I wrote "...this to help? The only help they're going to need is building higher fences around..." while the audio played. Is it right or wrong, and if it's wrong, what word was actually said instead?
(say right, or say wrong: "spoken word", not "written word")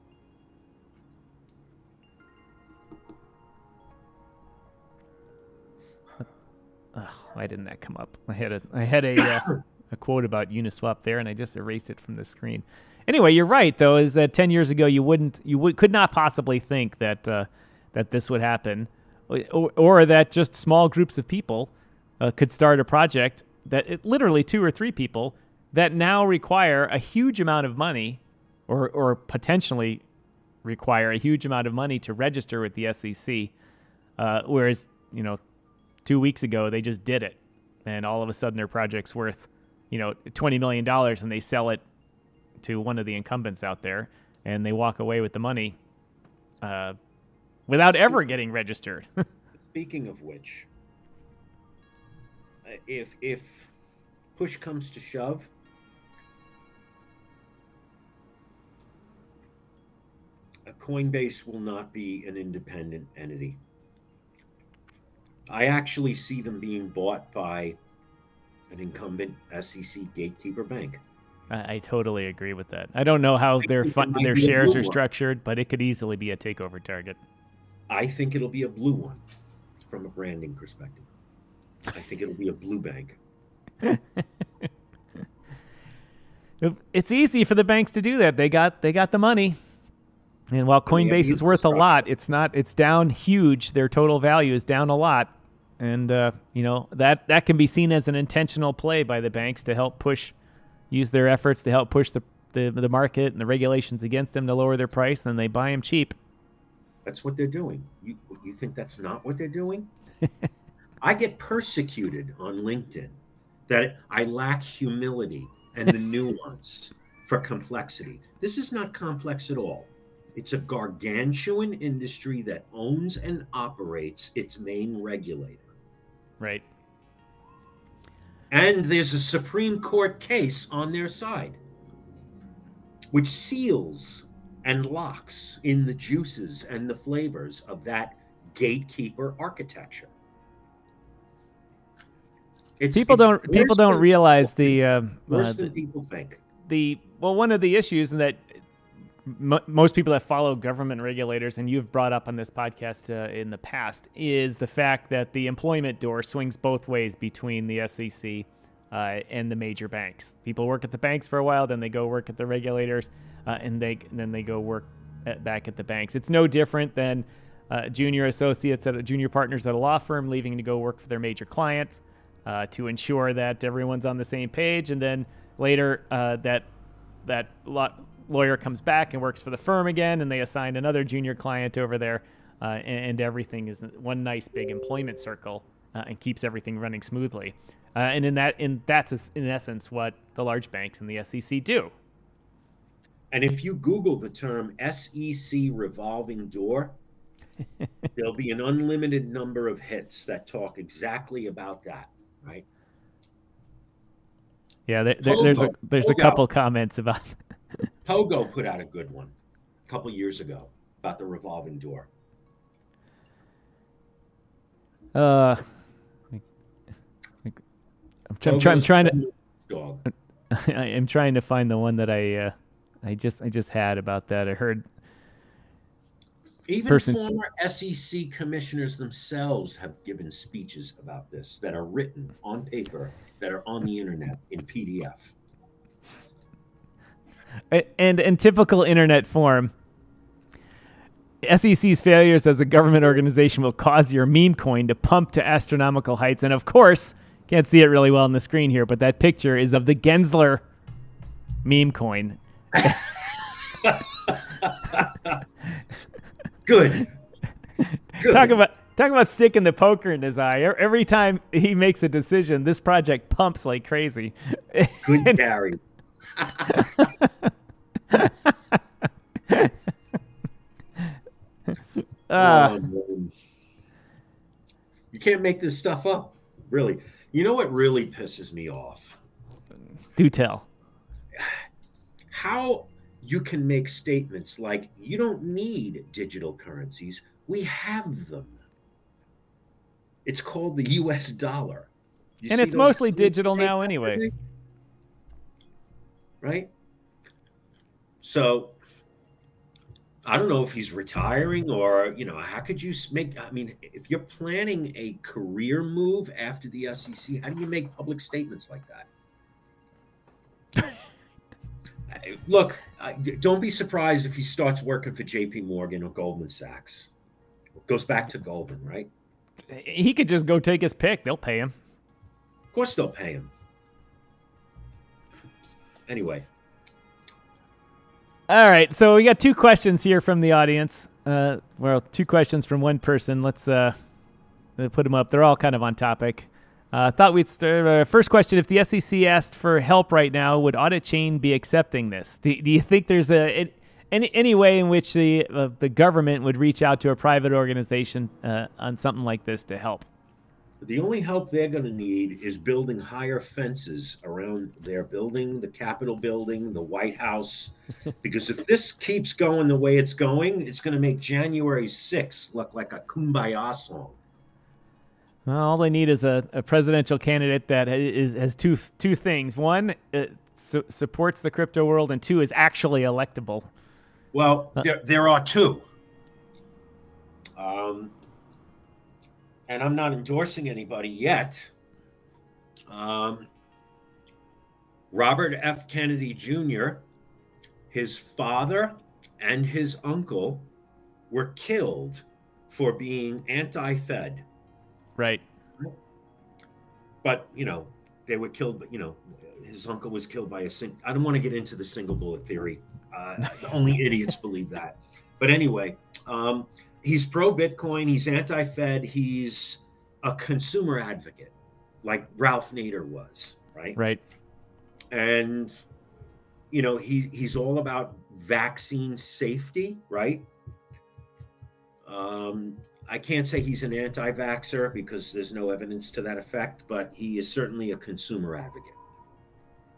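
right.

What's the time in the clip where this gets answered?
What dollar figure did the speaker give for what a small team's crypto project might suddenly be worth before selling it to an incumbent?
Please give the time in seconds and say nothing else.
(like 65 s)
40 s.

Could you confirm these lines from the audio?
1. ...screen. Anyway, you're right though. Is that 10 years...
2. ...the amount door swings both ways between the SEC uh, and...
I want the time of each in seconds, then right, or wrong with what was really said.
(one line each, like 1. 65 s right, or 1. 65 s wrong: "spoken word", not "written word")
1. 12 s right
2. 155 s wrong: "employment", not "amount".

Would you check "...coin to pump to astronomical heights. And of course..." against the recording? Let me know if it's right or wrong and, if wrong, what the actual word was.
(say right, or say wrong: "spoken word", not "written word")
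right.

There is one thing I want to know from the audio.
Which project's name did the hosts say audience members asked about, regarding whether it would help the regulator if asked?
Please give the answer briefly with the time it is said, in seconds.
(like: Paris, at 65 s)
Auditchain, at 340 s.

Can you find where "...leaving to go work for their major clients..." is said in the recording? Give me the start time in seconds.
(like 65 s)
170 s.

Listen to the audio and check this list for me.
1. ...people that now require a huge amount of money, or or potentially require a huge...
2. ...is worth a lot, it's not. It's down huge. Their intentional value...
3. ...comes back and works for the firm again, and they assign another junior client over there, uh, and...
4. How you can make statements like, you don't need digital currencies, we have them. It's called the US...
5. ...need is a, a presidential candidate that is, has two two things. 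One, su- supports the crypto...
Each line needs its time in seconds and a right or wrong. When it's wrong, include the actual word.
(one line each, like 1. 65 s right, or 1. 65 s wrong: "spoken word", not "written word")
1. 24 s right
2. 91 s wrong: "total", not "intentional"
3. 178 s right
4. 282 s right
5. 365 s right.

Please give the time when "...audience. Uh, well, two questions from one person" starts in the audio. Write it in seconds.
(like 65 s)
330 s.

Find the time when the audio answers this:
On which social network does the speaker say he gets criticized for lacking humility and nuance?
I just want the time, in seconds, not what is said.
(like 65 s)
112 s.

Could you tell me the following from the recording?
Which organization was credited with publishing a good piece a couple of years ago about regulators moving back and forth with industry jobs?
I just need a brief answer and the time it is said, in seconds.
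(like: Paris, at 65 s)
Pogo, at 208 s.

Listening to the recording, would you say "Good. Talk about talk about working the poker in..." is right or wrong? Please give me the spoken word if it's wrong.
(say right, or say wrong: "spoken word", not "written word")
wrong: "sticking", not "working".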